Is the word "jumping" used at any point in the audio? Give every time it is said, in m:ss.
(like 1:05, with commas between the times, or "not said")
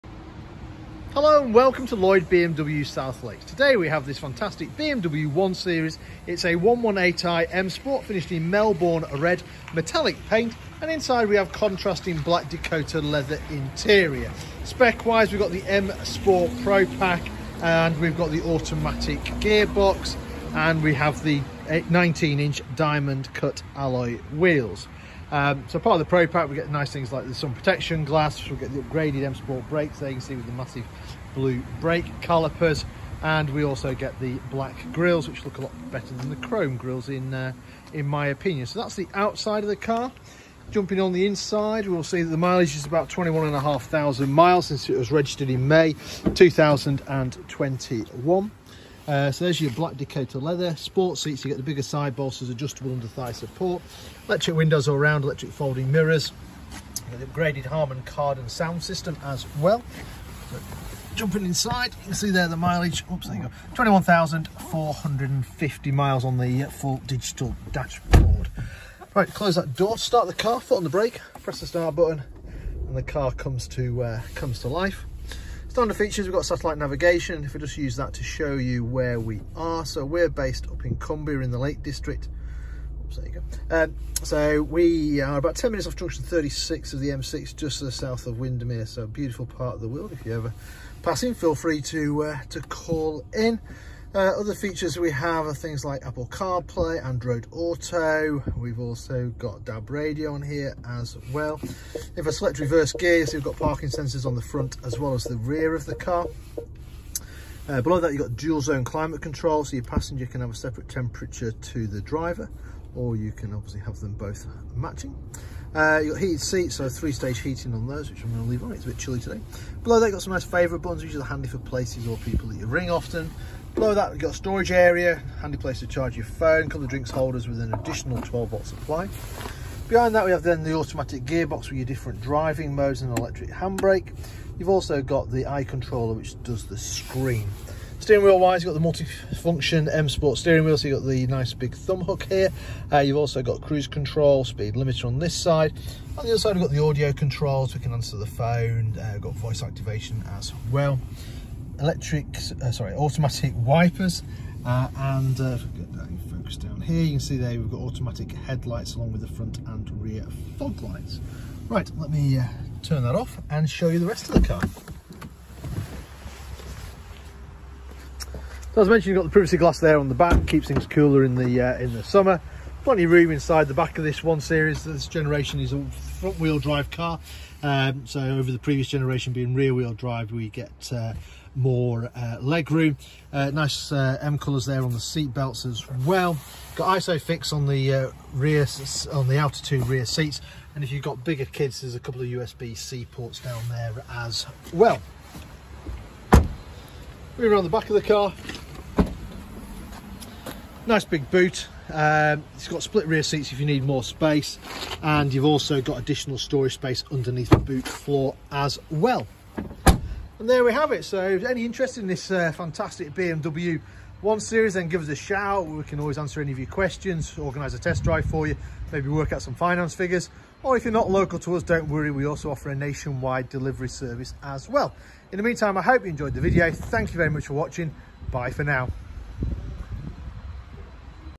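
0:40, 1:01.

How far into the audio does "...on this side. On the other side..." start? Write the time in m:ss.
2:25.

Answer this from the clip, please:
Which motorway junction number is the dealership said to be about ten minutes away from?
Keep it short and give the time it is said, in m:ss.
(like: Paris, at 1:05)
36, at 1:25.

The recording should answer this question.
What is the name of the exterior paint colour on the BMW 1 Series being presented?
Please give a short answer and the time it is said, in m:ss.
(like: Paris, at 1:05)
Melbourne red metallic, at 0:08.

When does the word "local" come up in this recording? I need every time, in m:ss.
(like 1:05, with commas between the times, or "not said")
3:41.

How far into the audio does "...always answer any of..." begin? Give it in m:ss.
3:35.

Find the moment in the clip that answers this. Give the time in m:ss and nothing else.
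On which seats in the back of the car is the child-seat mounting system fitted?
3:09.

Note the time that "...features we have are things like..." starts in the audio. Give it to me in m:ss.
1:34.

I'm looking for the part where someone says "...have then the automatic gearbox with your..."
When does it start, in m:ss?
2:10.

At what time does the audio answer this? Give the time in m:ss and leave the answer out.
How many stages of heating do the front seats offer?
1:56.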